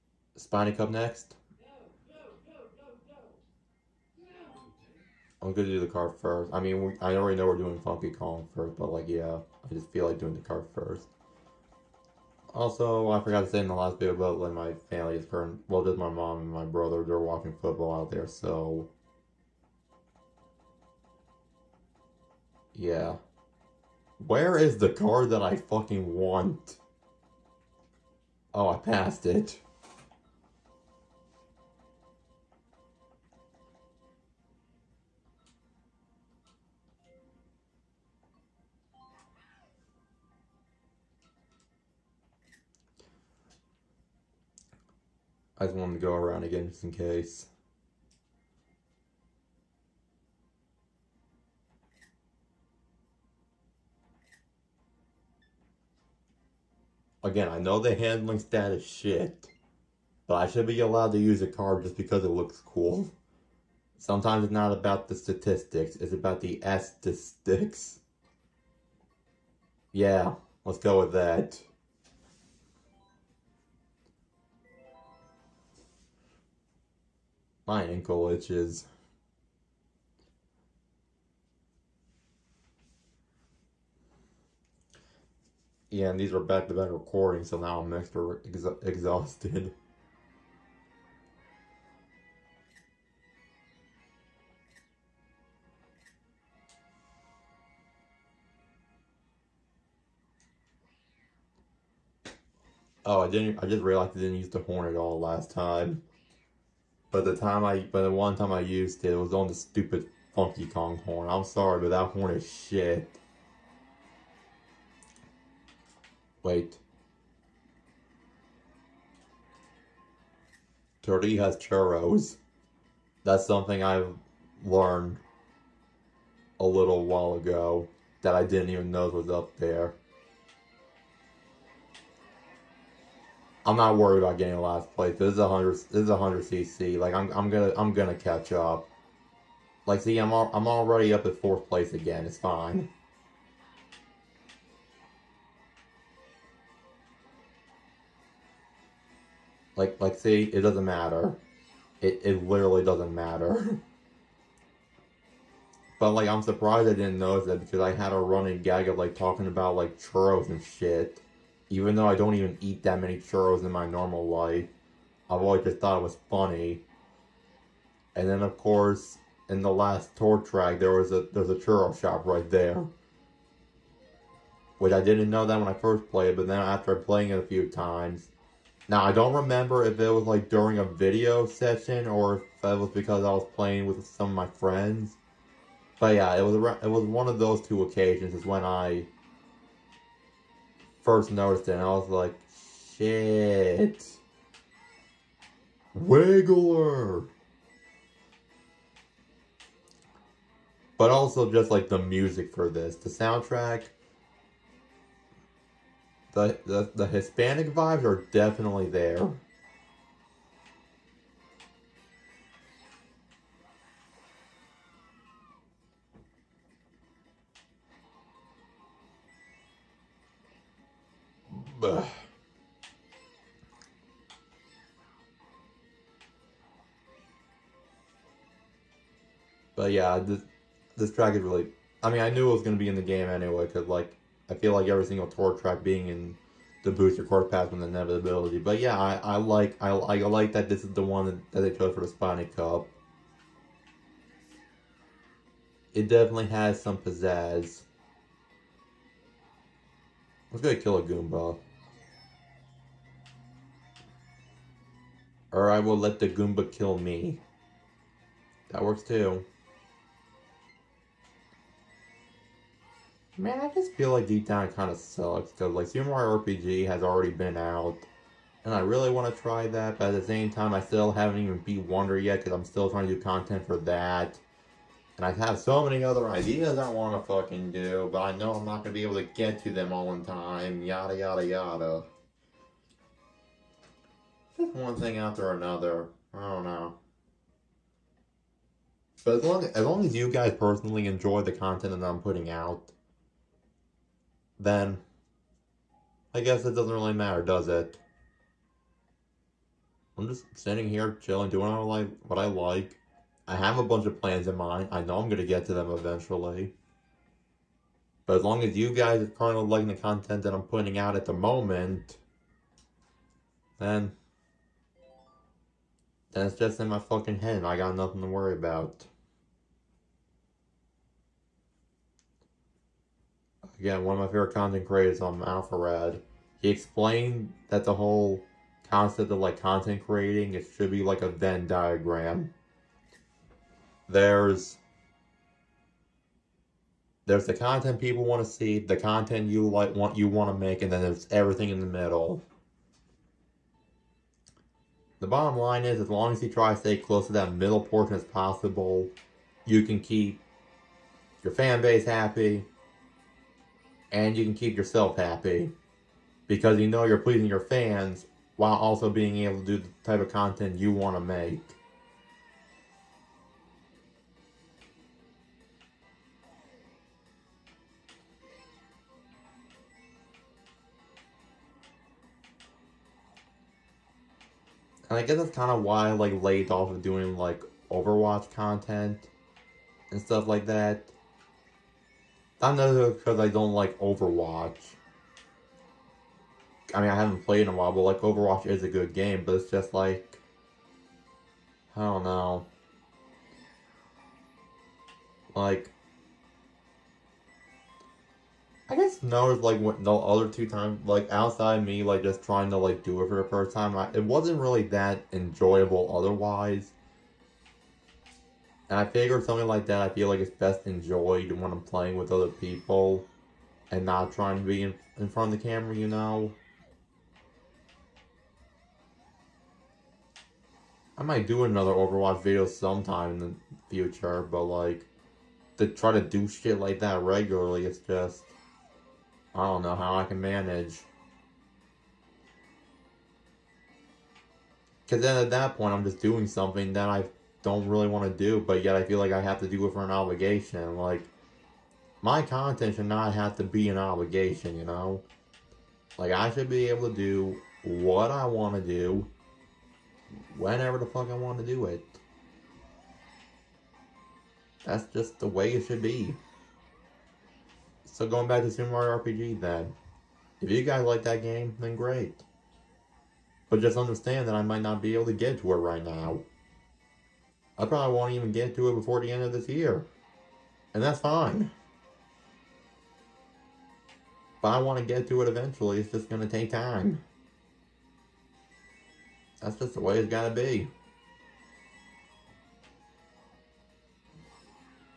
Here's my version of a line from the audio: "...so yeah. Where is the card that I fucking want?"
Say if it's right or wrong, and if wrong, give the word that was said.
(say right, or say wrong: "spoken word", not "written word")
right.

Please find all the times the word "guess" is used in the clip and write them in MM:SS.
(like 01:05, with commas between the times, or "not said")
04:56, 06:15, 06:38.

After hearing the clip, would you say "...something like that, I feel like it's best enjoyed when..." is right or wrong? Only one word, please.
right.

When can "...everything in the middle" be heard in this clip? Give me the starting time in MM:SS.
05:41.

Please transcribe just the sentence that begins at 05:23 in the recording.
Again, one of my favorite content creators on AlphaRad.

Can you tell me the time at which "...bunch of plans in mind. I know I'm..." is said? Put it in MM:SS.
05:03.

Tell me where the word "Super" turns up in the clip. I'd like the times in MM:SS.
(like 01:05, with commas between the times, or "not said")
04:25, 07:38.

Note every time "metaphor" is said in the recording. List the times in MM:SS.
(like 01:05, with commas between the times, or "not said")
not said.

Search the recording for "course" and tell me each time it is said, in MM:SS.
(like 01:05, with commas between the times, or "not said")
02:48, 03:57.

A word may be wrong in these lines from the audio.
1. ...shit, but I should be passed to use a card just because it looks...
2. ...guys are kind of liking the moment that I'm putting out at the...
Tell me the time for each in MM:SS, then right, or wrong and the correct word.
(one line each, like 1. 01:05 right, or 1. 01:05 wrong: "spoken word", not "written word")
1. 00:58 wrong: "allowed", not "passed"
2. 05:08 wrong: "content", not "moment".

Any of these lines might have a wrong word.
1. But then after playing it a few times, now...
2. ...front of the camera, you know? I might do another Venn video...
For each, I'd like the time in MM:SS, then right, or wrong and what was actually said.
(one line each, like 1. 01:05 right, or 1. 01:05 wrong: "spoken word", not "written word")
1. 02:56 right
2. 06:55 wrong: "Overwatch", not "Venn".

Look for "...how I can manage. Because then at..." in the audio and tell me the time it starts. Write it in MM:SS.
07:09.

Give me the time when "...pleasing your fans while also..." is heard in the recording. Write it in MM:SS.
05:57.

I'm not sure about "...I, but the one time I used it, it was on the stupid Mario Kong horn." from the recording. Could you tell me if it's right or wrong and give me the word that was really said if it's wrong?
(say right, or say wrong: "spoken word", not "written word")
wrong: "Funky", not "Mario".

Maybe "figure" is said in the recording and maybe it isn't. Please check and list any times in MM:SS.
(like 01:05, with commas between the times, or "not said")
06:49.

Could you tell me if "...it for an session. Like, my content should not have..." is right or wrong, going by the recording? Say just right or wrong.
wrong.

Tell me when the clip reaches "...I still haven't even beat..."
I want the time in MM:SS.
04:30.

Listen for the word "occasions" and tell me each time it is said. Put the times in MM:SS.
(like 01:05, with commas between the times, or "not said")
03:07.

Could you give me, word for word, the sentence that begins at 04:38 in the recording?
But I know I'm not gonna be able to get to them all in time.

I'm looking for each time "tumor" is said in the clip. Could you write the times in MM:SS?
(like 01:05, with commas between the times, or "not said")
not said.